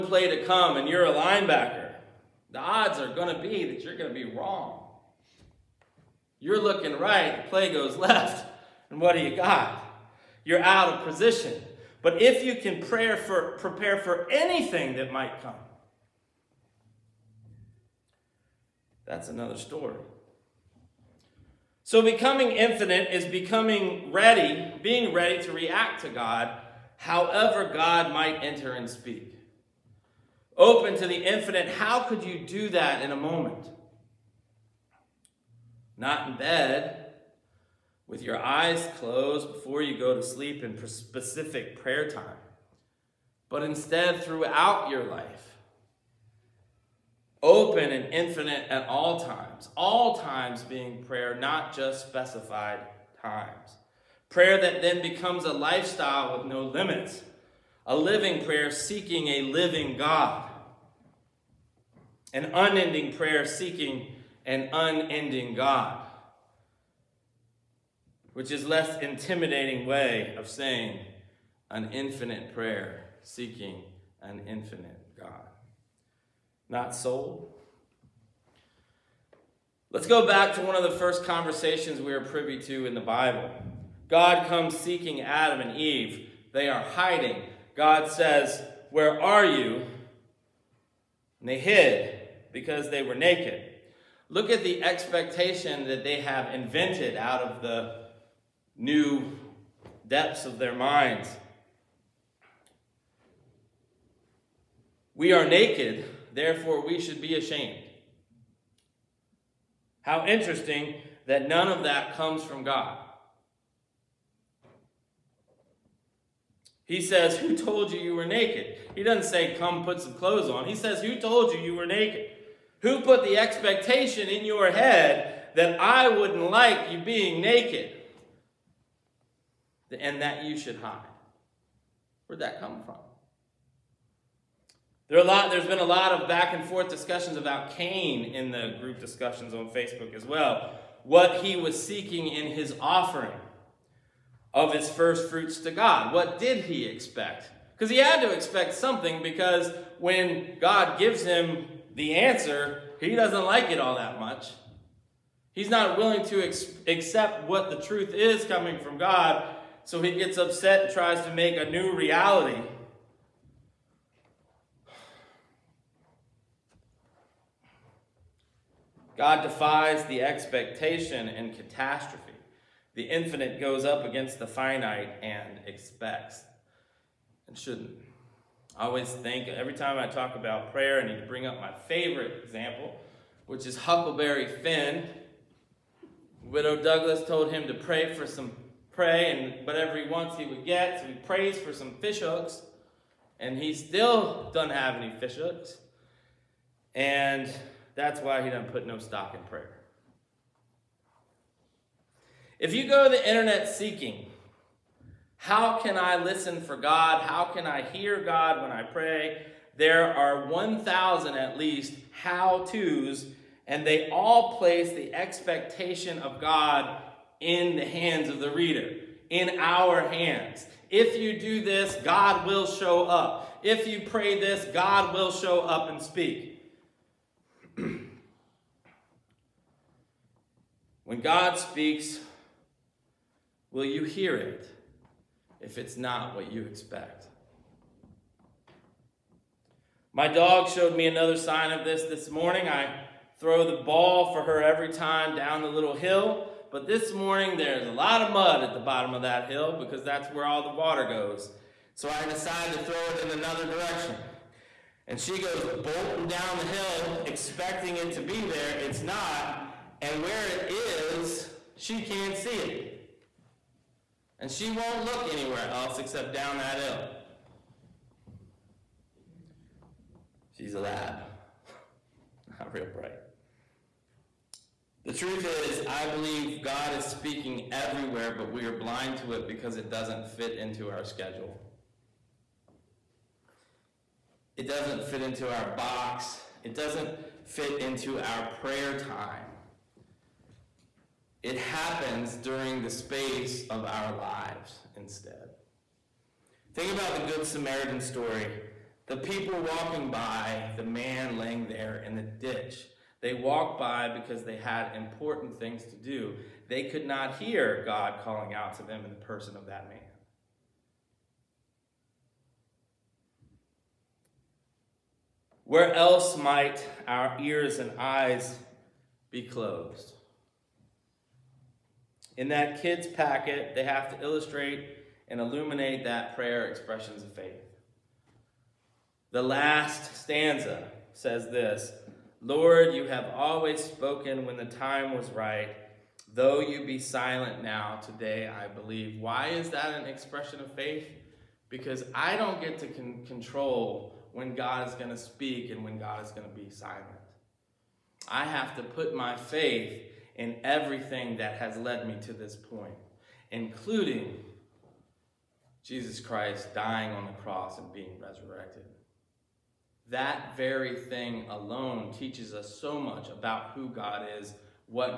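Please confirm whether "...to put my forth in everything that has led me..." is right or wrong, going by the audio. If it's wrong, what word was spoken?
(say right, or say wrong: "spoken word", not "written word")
wrong: "faith", not "forth".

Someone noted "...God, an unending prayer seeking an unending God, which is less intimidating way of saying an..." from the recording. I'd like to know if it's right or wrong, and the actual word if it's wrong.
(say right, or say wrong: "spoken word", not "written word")
right.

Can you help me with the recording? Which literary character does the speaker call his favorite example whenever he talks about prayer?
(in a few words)
Huckleberry Finn.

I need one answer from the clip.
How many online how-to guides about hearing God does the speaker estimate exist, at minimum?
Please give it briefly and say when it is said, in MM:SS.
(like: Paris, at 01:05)
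1,000, at 03:30.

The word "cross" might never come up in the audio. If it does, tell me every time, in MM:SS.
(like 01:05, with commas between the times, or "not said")
05:57.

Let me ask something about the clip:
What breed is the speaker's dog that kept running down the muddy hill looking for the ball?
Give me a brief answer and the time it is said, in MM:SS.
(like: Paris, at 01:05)
lab, at 04:30.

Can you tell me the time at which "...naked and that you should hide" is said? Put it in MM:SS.
02:07.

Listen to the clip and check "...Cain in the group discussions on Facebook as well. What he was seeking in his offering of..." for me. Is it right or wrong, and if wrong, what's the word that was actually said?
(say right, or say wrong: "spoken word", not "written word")
right.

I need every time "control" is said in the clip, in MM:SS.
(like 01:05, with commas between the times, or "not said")
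05:43.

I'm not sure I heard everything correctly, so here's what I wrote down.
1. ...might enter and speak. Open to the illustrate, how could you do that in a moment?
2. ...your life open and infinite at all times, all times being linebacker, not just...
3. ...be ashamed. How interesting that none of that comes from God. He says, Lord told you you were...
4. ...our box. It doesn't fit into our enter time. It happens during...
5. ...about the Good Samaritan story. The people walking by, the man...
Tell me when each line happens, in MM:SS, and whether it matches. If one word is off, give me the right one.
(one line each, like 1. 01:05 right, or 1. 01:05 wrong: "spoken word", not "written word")
1. 00:28 wrong: "infinite", not "illustrate"
2. 00:44 wrong: "prayer", not "linebacker"
3. 01:47 wrong: "Who", not "Lord"
4. 04:45 wrong: "prayer", not "enter"
5. 04:56 right.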